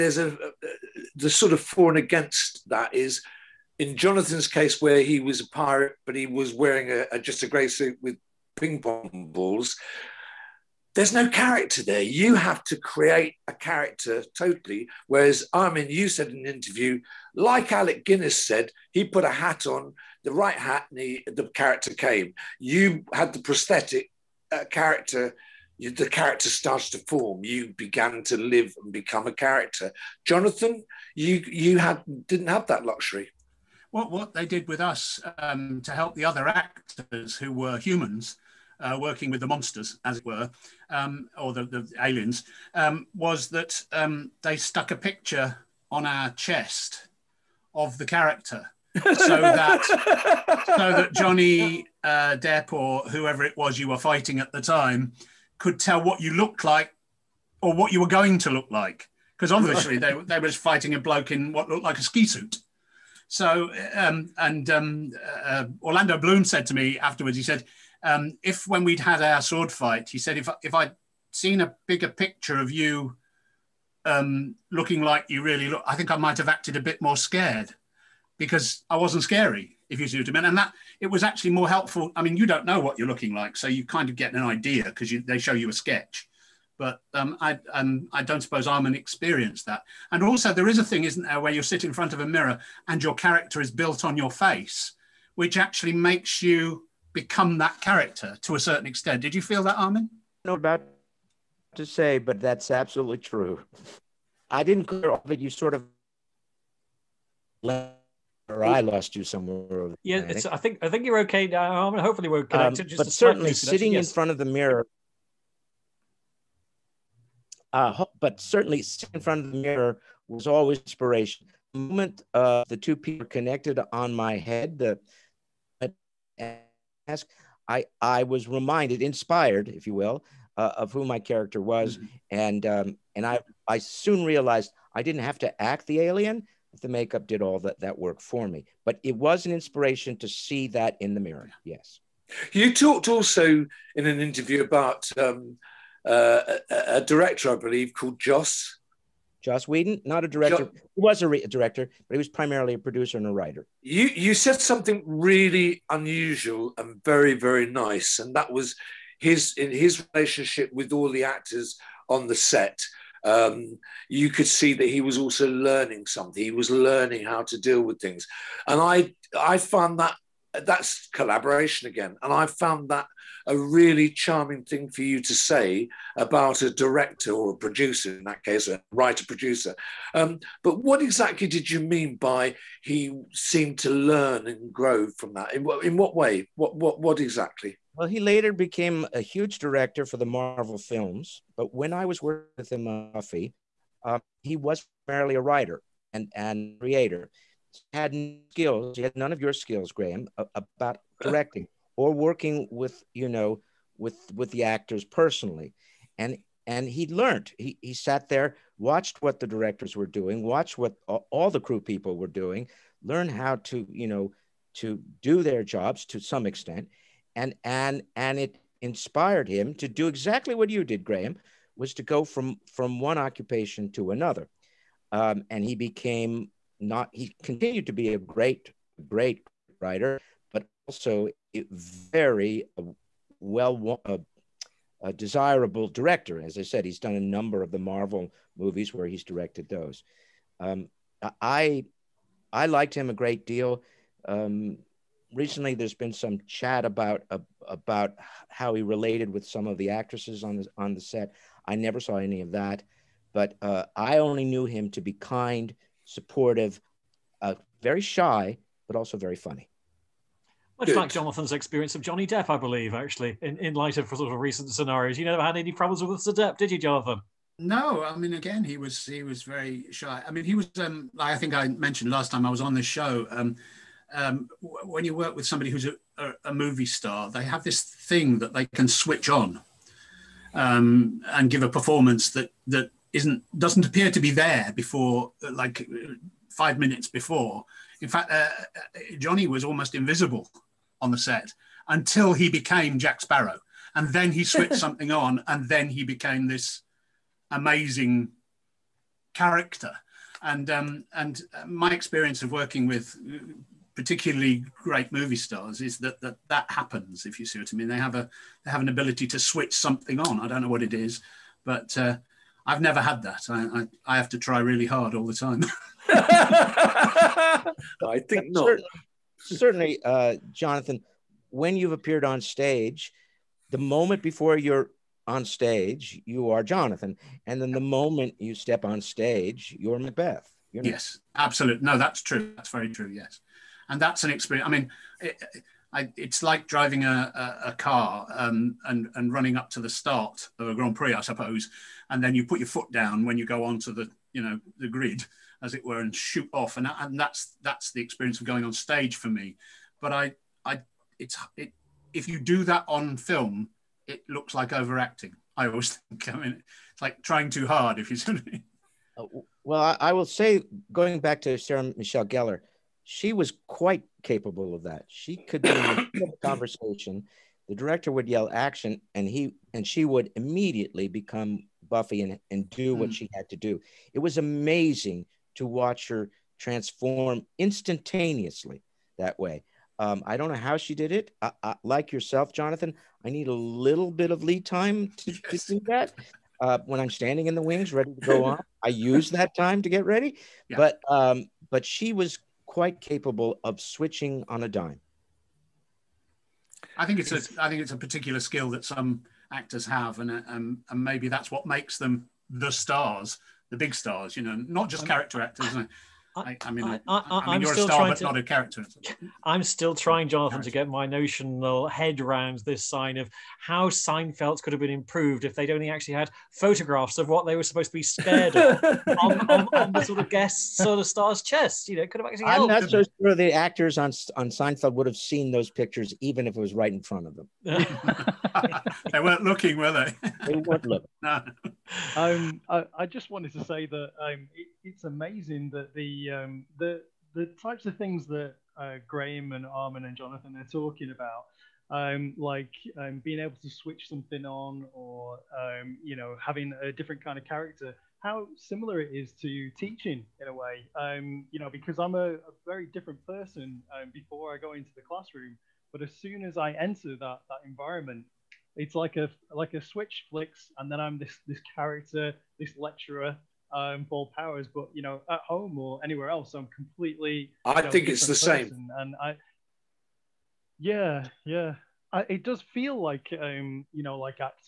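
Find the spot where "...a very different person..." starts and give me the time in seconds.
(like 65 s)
452 s.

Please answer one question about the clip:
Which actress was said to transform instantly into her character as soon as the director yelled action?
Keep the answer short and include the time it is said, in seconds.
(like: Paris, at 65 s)
Sarah Michelle Gellar, at 361 s.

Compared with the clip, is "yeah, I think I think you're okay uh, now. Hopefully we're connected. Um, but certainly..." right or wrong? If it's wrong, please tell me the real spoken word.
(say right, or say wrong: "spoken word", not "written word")
right.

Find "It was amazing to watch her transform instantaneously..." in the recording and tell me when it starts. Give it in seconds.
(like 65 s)
374 s.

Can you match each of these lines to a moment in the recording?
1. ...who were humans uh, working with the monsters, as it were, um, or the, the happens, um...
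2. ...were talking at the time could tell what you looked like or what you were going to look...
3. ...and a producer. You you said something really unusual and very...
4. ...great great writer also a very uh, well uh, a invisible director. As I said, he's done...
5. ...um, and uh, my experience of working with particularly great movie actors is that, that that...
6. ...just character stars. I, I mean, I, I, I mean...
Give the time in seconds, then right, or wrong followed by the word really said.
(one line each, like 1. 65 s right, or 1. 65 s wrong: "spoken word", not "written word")
1. 37 s wrong: "aliens", not "happens"
2. 53 s wrong: "fighting", not "talking"
3. 153 s wrong: "writer", not "producer"
4. 228 s wrong: "desirable", not "invisible"
5. 300 s wrong: "stars", not "actors"
6. 404 s wrong: "actors", not "stars".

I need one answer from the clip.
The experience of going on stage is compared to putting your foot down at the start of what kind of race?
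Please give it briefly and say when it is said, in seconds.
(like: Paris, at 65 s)
Grand Prix, at 340 s.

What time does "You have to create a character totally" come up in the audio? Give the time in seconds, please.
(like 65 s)
12 s.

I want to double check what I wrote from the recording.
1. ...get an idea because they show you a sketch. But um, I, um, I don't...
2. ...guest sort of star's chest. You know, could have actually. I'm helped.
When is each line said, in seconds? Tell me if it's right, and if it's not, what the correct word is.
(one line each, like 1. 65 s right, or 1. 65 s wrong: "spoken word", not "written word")
1. 84 s right
2. 420 s right.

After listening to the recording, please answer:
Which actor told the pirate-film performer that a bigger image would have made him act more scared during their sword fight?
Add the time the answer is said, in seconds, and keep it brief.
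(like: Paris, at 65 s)
Orlando Bloom, at 65 s.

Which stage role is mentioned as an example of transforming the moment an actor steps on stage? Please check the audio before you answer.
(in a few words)
Macbeth.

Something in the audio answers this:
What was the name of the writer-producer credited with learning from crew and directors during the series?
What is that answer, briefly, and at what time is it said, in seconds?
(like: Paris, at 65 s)
Joss Whedon, at 149 s.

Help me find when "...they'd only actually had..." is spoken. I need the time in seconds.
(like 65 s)
415 s.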